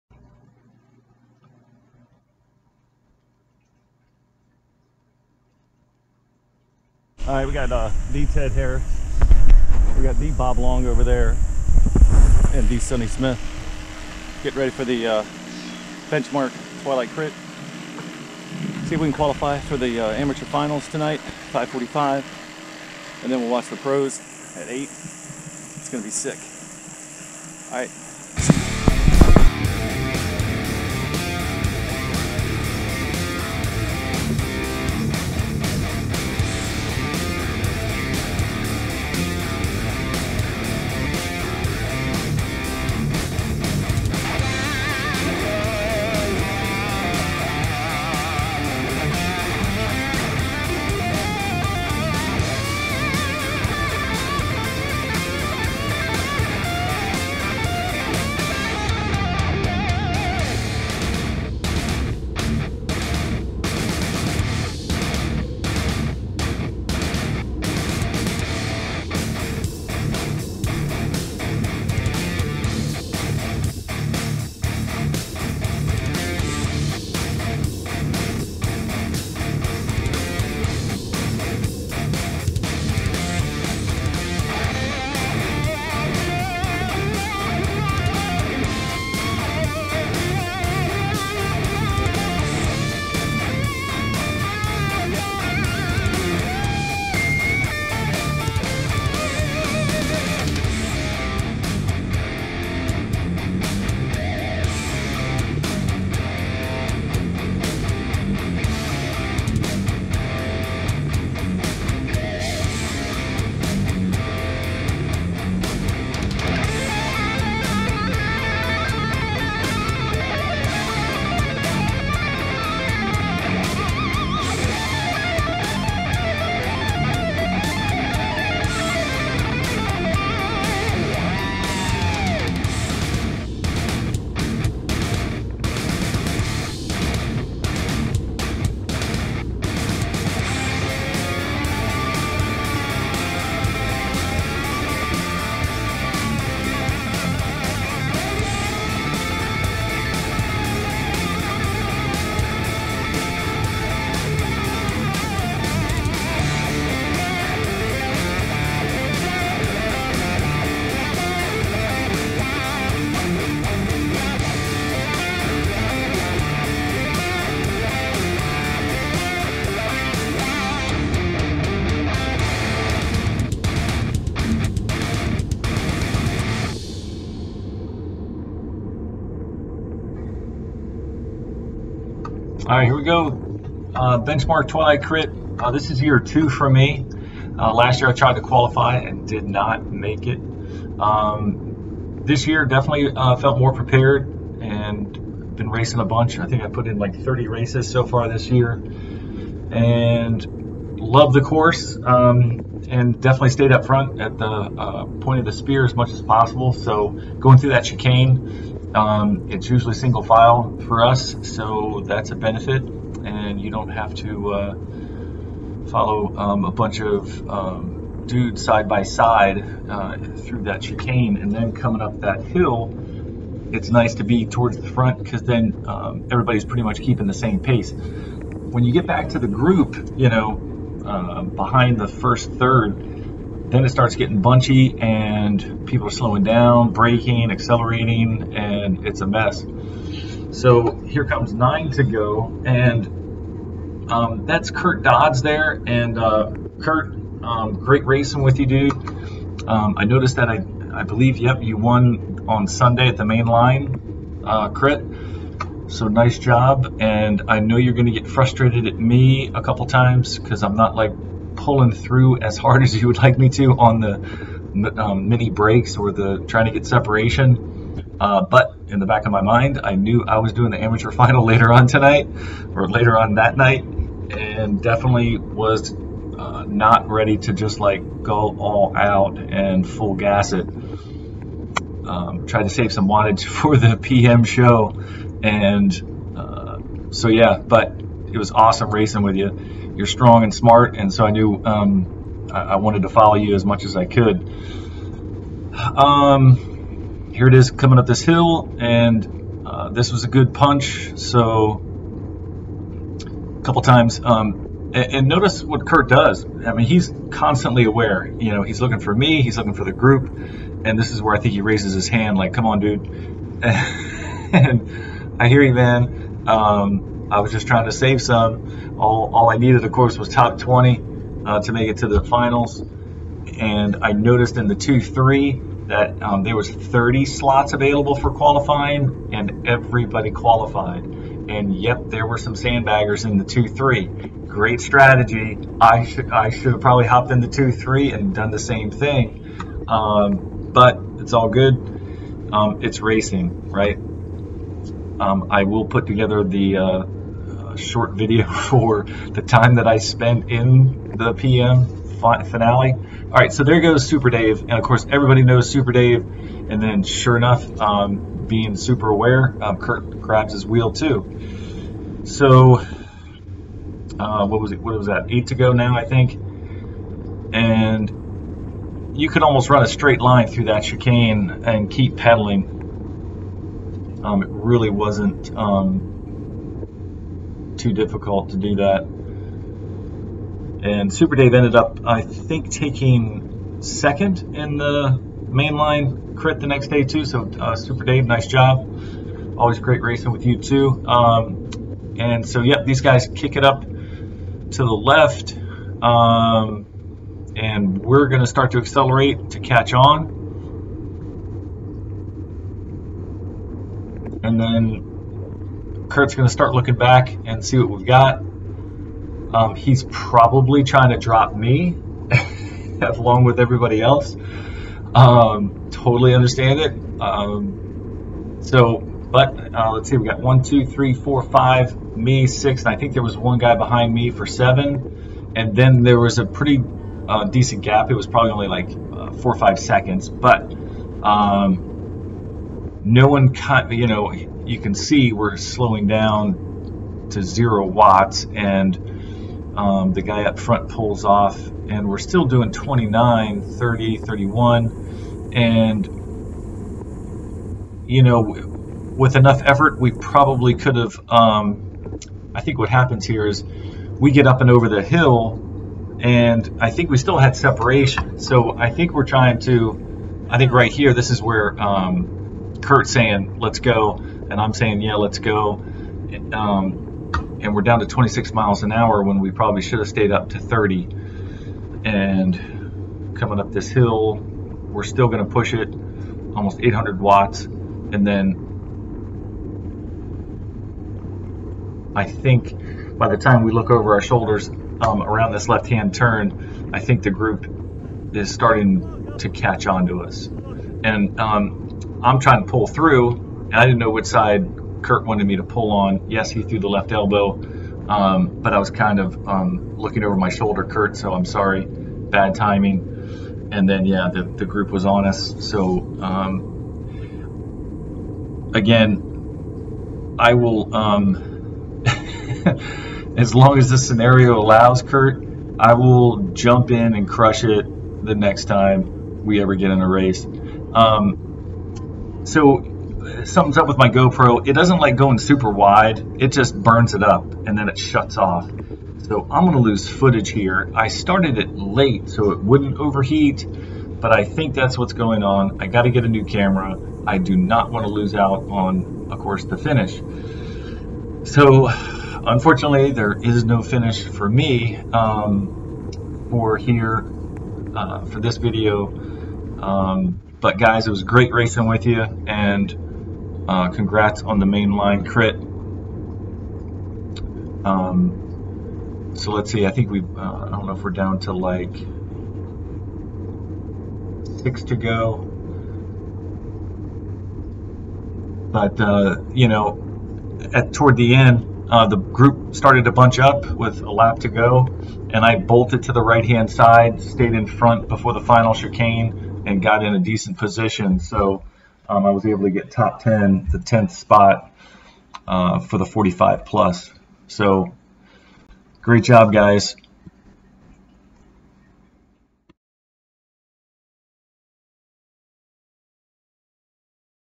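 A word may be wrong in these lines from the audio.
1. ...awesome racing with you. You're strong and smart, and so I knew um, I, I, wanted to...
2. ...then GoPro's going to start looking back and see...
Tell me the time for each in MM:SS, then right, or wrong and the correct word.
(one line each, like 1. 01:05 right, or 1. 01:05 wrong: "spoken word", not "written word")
1. 04:48 right
2. 06:44 wrong: "Kurt", not "GoPro".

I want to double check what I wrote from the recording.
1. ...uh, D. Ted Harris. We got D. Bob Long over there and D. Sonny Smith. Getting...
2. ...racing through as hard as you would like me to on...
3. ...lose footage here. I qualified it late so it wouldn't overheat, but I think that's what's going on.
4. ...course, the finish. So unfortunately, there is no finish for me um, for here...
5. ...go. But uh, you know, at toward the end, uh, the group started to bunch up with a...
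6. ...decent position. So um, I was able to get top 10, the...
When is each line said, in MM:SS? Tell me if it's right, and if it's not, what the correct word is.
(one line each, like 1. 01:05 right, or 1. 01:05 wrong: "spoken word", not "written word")
1. 00:07 right
2. 04:21 wrong: "pulling", not "racing"
3. 08:49 wrong: "started", not "qualified"
4. 08:59 right
5. 09:24 right
6. 09:40 right.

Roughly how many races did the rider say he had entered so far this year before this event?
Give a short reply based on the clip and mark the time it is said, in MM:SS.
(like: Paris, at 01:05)
30, at 03:17.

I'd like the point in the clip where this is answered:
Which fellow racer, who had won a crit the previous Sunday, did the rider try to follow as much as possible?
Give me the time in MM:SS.
04:04.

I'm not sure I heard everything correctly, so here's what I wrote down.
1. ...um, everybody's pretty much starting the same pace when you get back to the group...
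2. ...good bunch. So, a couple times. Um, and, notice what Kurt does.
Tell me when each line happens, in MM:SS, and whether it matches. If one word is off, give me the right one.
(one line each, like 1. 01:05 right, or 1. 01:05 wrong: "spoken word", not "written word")
1. 03:45 wrong: "keeping", not "starting"
2. 05:00 wrong: "punch", not "bunch".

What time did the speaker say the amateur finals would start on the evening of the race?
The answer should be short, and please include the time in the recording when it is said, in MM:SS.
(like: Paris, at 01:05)
5:45, at 00:21.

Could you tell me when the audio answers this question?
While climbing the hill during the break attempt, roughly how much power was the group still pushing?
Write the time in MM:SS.
07:56.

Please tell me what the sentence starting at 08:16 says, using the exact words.
Yes, he threw the left elbow, um, but I was kind of um, looking over my shoulder, Kurt, so I'm sorry.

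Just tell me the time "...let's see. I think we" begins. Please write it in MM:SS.
09:19.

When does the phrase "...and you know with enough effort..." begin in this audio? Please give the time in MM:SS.
07:25.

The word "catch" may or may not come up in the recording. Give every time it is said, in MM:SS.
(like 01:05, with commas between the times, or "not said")
06:39, 08:09.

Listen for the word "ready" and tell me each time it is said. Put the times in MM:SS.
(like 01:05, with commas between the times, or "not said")
00:14, 04:37.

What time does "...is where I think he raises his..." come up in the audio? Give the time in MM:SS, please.
05:11.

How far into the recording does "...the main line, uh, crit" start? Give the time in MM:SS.
04:13.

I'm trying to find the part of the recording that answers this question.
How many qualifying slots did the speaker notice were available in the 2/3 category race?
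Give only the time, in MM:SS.
05:26.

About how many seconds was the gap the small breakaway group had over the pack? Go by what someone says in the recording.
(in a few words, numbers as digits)
4 or 5 seconds.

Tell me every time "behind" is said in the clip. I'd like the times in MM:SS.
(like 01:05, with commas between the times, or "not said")
03:51, 07:03.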